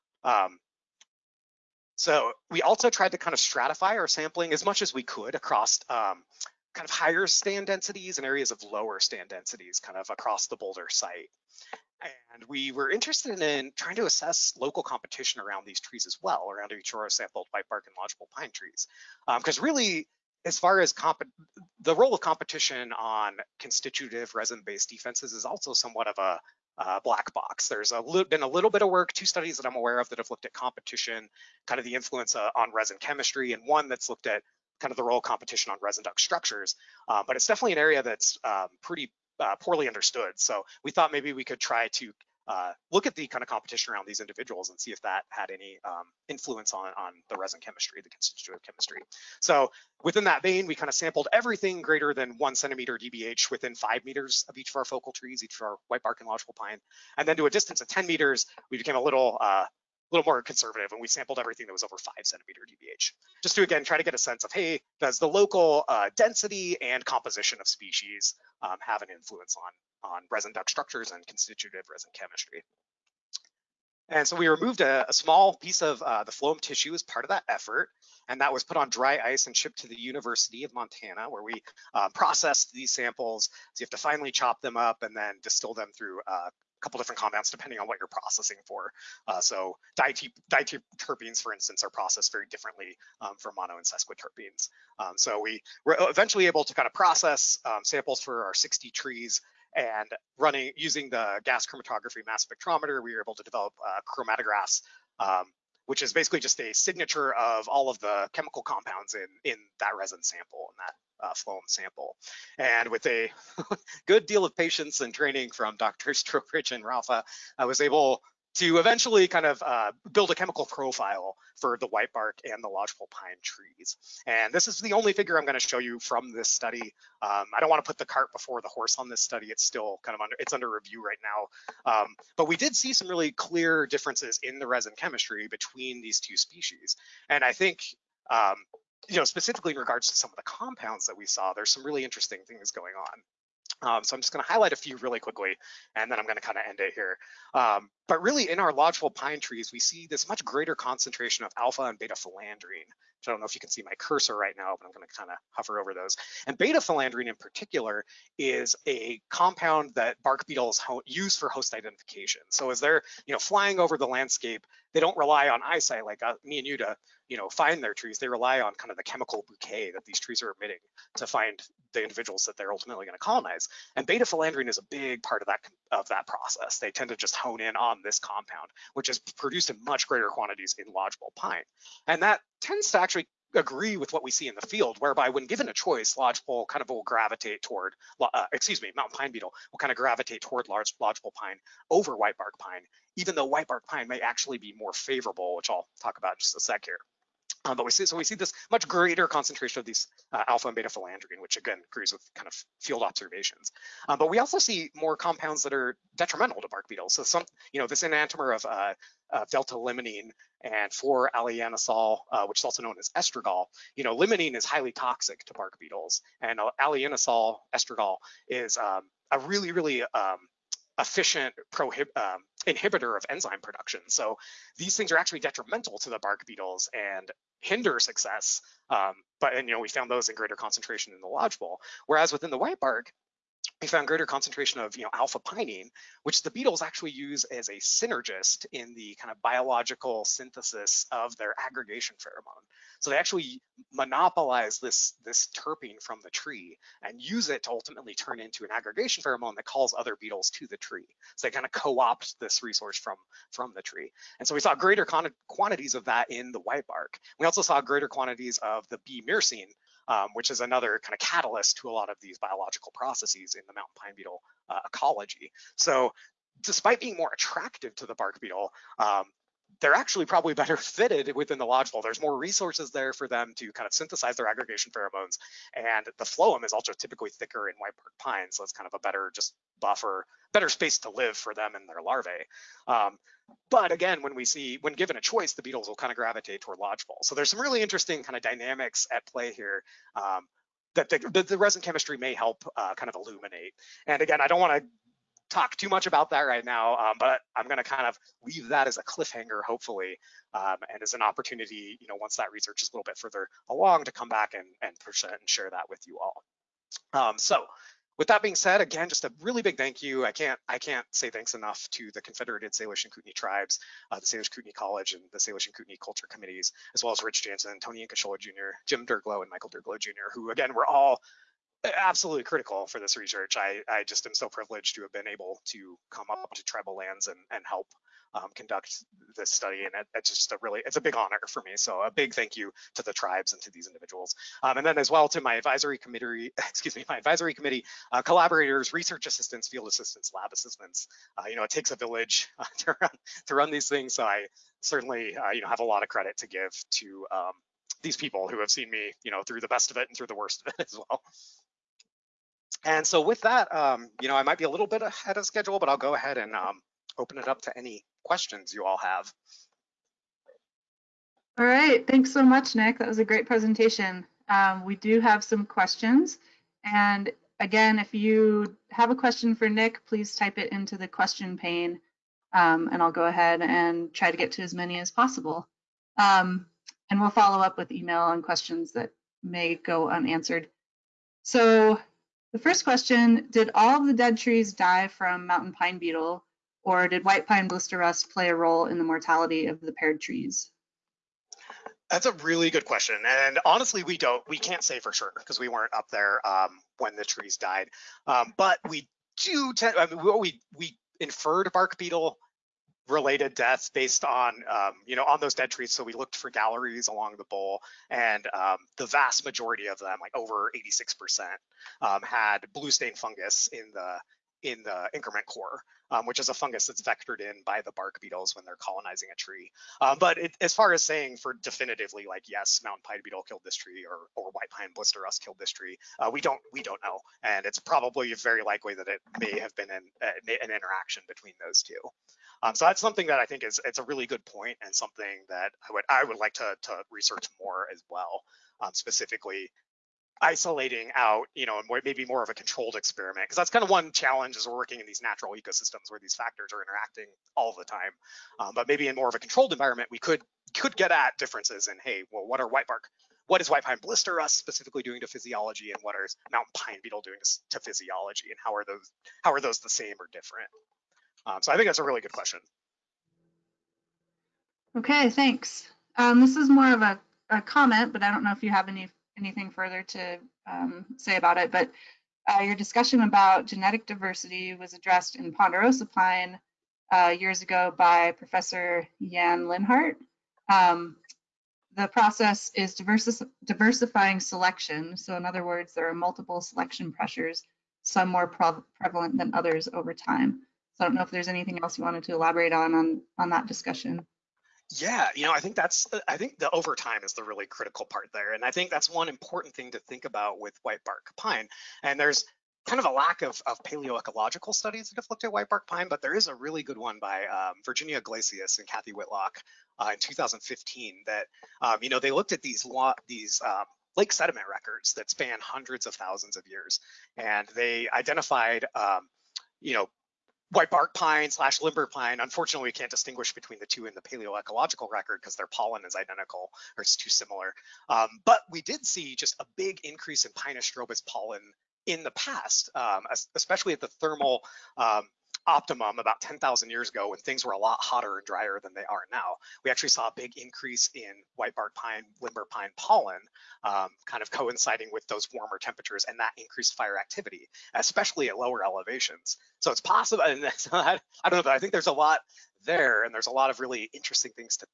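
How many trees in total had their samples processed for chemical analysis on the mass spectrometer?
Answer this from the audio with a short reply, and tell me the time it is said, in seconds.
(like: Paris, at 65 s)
60, at 98 s.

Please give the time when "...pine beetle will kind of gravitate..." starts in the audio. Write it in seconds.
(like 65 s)
189 s.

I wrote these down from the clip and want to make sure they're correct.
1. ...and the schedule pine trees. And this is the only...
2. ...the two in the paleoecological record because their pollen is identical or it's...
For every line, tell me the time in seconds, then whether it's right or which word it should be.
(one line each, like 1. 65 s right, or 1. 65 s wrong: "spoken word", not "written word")
1. 122 s wrong: "lodgepole", not "schedule"
2. 523 s right.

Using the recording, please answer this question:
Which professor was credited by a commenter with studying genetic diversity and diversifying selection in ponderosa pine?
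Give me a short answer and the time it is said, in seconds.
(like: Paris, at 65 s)
Yan Linhart, at 479 s.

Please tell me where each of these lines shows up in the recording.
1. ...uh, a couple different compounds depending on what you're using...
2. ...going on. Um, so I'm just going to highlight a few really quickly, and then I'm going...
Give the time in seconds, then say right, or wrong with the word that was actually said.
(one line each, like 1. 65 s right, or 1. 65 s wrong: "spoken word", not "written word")
1. 86 s wrong: "processing", not "using"
2. 142 s right.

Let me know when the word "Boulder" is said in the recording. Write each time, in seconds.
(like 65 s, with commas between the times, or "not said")
10 s.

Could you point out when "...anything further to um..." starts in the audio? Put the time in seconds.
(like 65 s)
469 s.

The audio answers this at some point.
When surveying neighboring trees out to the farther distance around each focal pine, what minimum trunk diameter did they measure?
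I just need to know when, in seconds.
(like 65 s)
61 s.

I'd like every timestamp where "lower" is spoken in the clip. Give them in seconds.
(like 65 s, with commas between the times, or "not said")
8 s, 548 s.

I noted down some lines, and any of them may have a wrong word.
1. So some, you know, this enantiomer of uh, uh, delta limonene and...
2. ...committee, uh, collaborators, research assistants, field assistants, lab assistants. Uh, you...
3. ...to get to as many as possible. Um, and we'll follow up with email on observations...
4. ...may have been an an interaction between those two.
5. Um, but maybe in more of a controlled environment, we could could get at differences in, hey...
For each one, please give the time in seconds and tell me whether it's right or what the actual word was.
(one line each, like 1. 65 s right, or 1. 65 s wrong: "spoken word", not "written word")
1. 207 s right
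2. 337 s right
3. 374 s wrong: "questions", not "observations"
4. 429 s right
5. 448 s right.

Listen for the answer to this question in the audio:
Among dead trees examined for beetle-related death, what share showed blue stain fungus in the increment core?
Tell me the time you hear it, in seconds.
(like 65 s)
410 s.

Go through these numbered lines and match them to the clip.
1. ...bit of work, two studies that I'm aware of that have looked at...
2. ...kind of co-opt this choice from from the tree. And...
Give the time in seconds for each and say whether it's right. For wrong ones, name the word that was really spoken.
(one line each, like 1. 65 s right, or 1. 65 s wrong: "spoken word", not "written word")
1. 28 s right
2. 251 s wrong: "resource", not "choice".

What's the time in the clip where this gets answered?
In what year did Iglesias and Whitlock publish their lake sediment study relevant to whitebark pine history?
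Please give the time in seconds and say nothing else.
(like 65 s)
510 s.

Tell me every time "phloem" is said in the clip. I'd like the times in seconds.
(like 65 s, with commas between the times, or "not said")
76 s, 111 s, 276 s.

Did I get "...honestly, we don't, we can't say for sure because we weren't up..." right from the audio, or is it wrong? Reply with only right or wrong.
right.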